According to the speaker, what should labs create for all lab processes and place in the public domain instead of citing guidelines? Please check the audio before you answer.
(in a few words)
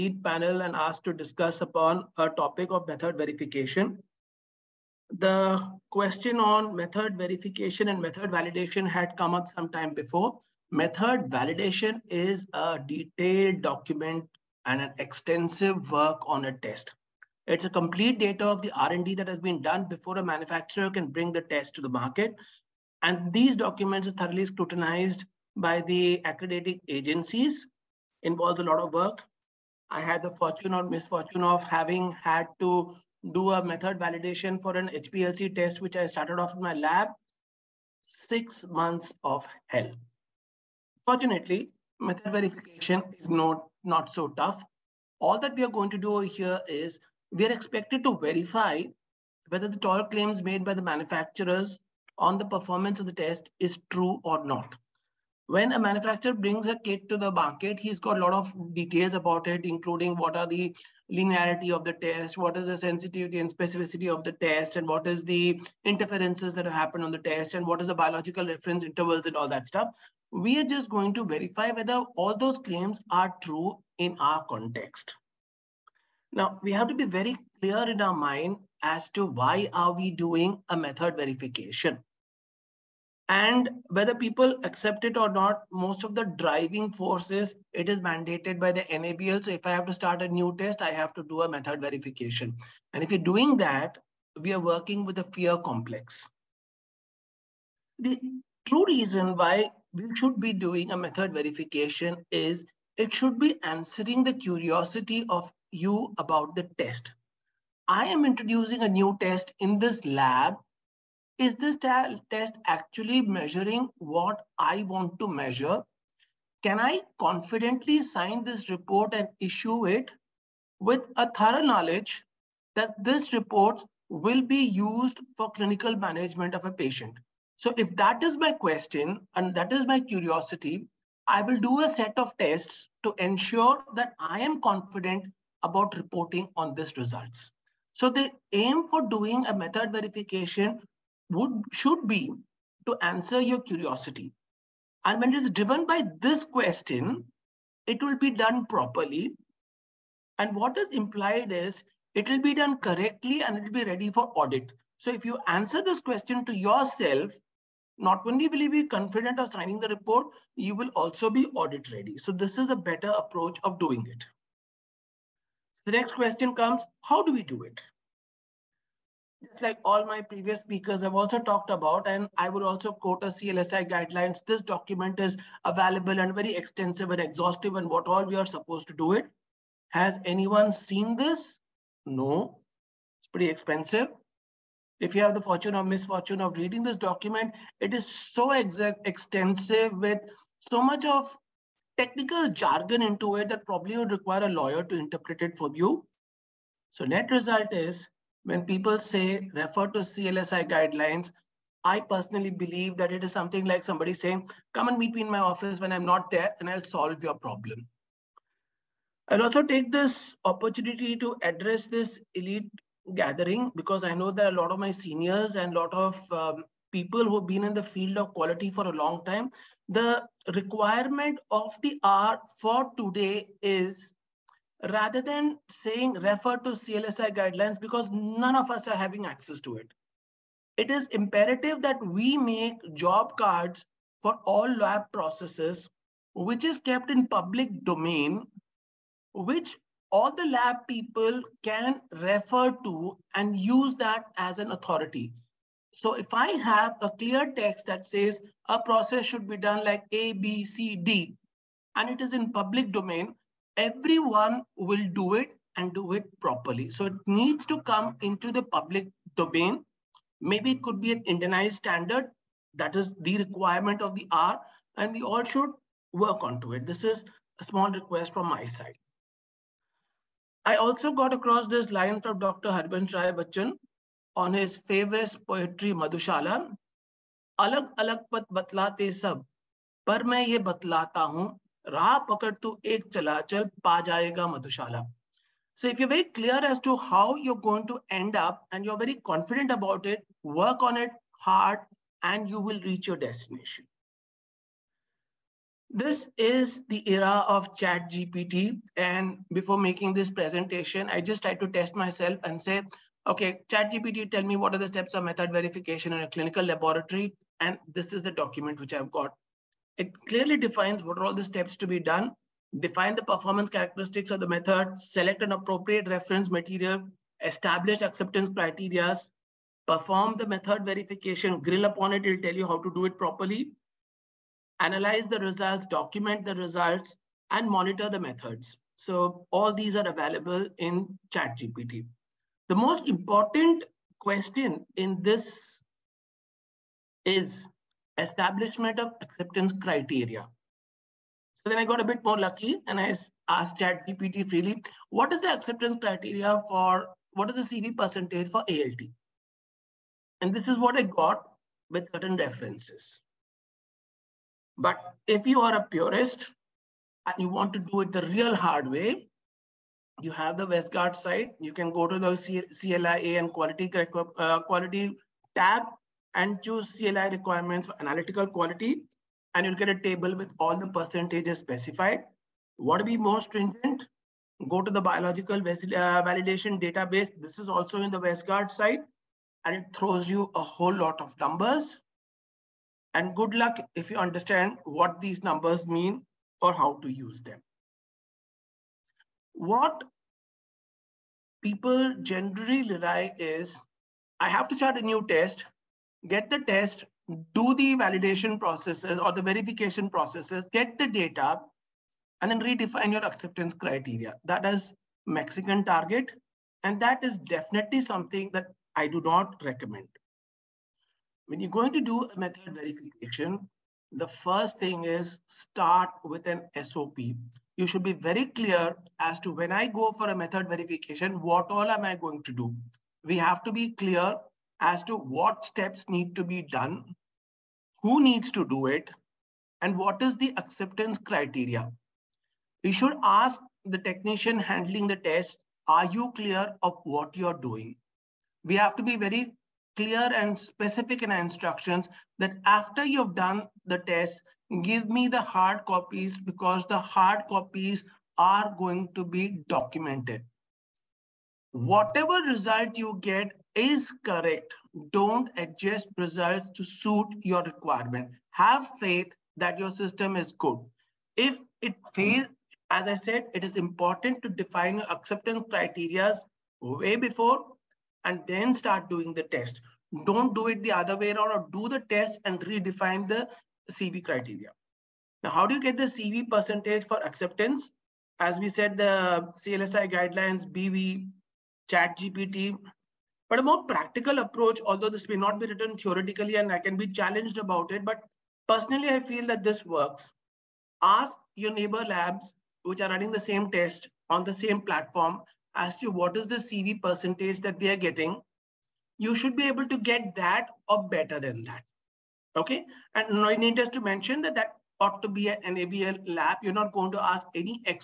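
Job cards.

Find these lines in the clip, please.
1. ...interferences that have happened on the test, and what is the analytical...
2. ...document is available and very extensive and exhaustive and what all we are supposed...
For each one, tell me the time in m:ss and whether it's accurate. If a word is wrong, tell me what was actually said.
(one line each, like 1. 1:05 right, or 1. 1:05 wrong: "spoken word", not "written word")
1. 1:05 wrong: "biological", not "analytical"
2. 2:54 right.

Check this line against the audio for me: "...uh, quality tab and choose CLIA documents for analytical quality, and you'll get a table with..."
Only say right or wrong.
wrong.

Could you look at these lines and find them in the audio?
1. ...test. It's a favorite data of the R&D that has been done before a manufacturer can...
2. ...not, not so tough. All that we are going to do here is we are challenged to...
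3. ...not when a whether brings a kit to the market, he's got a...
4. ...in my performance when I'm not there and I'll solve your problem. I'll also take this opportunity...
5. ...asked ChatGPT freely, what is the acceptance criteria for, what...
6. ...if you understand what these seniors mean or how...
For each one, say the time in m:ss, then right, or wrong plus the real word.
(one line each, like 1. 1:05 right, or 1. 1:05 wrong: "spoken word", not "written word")
1. 0:16 wrong: "complete", not "favorite"
2. 0:43 wrong: "expected", not "challenged"
3. 0:54 wrong: "manufacturer", not "whether"
4. 3:25 wrong: "office", not "performance"
5. 5:43 right
6. 6:24 wrong: "numbers", not "seniors".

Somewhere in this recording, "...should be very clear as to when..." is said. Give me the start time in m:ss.
6:57.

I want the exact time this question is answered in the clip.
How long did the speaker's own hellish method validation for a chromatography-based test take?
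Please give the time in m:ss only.
0:38.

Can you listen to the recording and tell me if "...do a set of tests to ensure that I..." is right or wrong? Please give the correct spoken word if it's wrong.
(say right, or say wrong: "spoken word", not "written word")
right.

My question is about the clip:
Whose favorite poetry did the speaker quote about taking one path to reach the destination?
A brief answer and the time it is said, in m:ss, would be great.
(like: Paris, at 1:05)
Harbans Rai Bachchan, at 4:32.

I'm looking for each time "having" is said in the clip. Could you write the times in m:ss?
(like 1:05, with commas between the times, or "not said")
0:31, 3:48.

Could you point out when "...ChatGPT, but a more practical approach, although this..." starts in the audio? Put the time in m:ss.
8:01.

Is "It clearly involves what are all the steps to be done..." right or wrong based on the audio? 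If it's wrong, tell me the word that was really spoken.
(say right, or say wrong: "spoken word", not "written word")
wrong: "defines", not "involves".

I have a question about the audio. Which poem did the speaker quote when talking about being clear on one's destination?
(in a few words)
Madhushala.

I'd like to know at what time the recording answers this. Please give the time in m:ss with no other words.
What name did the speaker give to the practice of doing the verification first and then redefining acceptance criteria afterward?
6:45.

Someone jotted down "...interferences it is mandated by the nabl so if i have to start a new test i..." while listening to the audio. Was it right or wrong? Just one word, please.
wrong.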